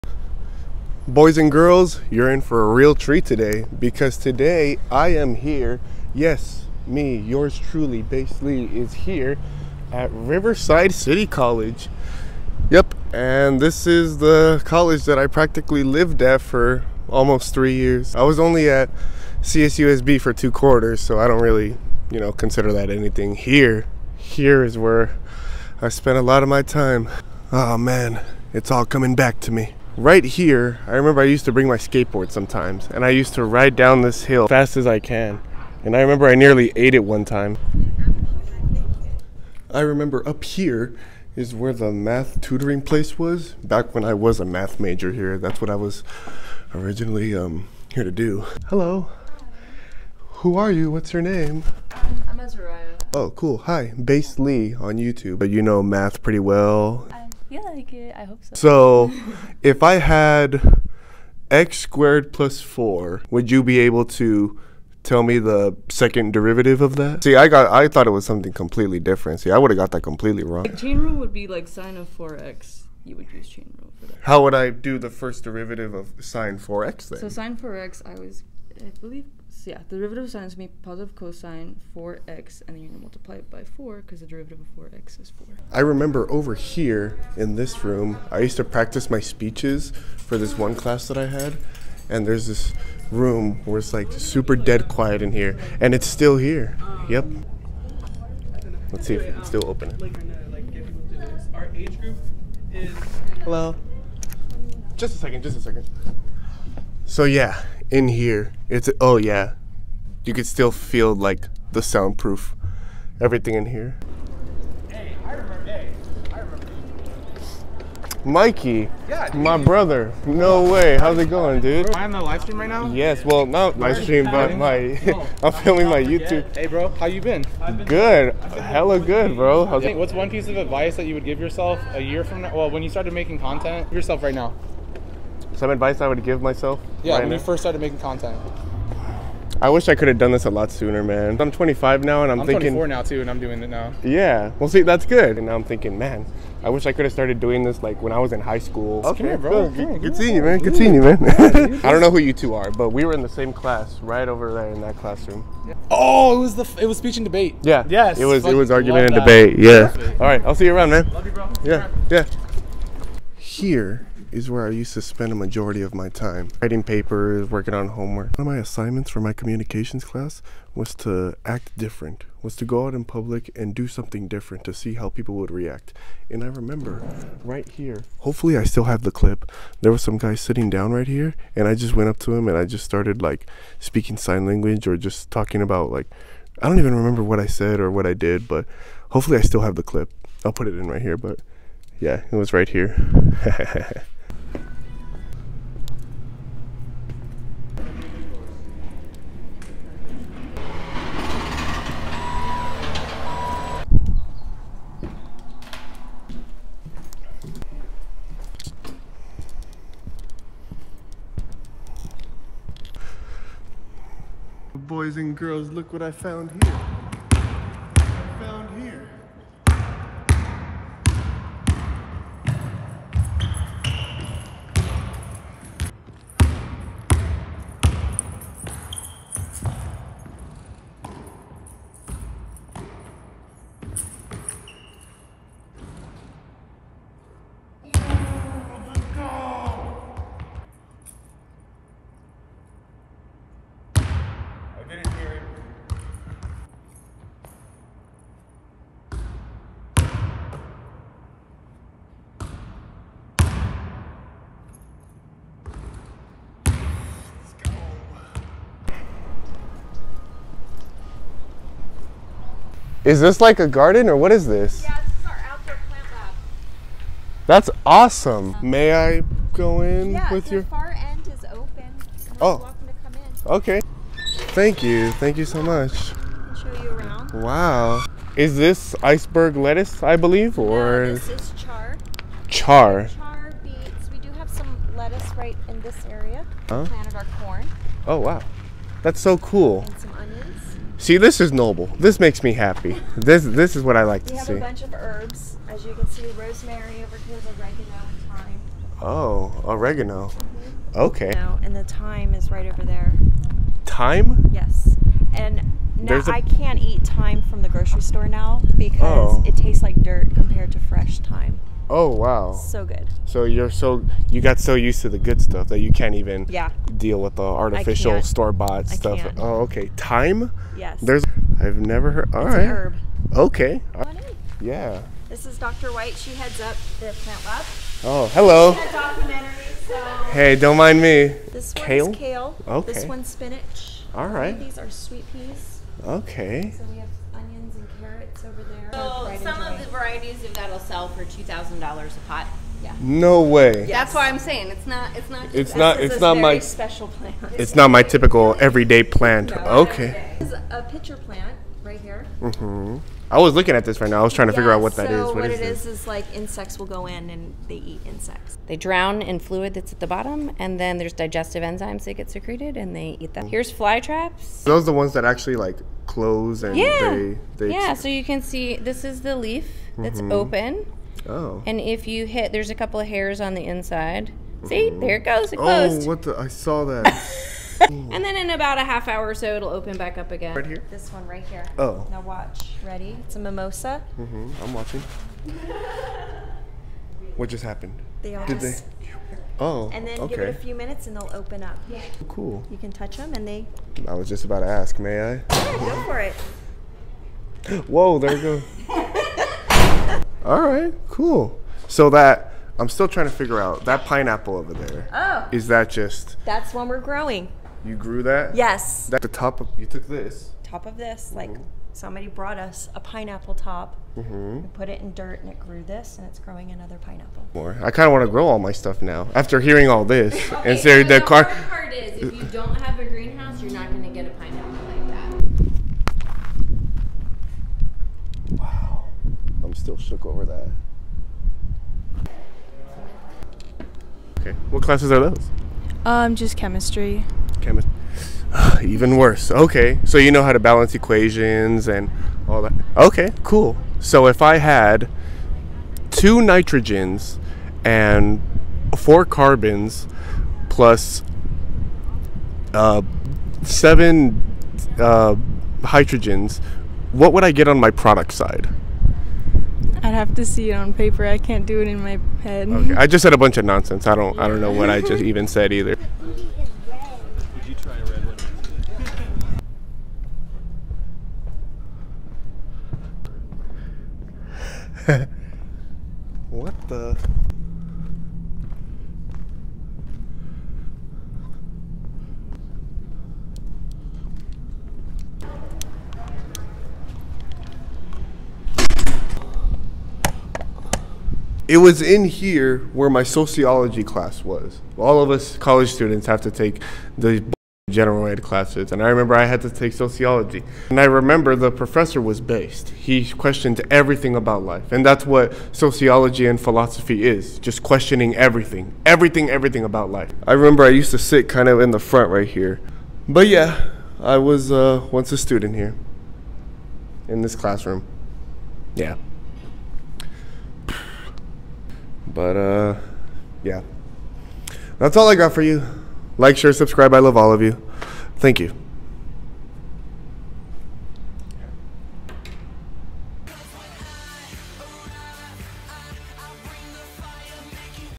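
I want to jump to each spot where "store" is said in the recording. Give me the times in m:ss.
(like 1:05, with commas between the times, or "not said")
5:08, 5:18.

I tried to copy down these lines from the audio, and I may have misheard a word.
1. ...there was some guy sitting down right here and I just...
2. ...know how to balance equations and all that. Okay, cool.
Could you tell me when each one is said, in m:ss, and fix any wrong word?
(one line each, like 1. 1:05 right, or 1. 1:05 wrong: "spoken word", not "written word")
1. 2:59 right
2. 7:20 right.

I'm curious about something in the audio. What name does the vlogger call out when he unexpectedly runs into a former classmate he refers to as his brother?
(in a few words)
Mikey.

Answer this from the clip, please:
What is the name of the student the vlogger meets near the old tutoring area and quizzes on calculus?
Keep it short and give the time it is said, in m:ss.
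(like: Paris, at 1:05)
Azariah, at 0:52.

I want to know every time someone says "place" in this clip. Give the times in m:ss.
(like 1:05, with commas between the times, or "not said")
0:42.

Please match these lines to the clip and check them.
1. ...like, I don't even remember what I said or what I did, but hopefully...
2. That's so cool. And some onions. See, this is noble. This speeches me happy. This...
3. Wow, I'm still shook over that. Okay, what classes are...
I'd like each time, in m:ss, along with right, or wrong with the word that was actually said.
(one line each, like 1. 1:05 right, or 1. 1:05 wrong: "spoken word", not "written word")
1. 3:05 right
2. 4:49 wrong: "makes", not "speeches"
3. 7:08 right.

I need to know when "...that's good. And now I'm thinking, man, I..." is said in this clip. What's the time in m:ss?
2:24.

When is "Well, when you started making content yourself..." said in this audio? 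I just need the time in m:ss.
2:12.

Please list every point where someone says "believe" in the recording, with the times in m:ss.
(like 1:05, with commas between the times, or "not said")
1:19, 4:40.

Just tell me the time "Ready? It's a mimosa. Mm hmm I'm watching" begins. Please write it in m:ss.
6:22.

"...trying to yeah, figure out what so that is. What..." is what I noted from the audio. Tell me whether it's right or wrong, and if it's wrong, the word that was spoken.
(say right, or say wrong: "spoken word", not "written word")
right.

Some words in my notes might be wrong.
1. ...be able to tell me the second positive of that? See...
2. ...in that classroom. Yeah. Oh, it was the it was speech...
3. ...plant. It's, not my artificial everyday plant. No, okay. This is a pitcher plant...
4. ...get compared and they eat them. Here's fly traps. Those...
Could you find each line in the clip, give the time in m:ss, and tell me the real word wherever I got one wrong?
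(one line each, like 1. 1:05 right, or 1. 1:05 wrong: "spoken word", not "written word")
1. 1:03 wrong: "derivative", not "positive"
2. 2:34 right
3. 5:47 wrong: "typical", not "artificial"
4. 6:02 wrong: "secreted", not "compared".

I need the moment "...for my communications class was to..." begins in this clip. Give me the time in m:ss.
2:49.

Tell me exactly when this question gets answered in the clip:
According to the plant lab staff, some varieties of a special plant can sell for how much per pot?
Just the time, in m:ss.
5:41.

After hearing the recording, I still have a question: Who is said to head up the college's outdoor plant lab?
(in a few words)
Dr. White.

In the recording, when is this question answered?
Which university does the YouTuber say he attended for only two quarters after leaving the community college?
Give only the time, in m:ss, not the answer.
0:19.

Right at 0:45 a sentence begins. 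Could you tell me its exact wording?
That's what I was originally um, here to do.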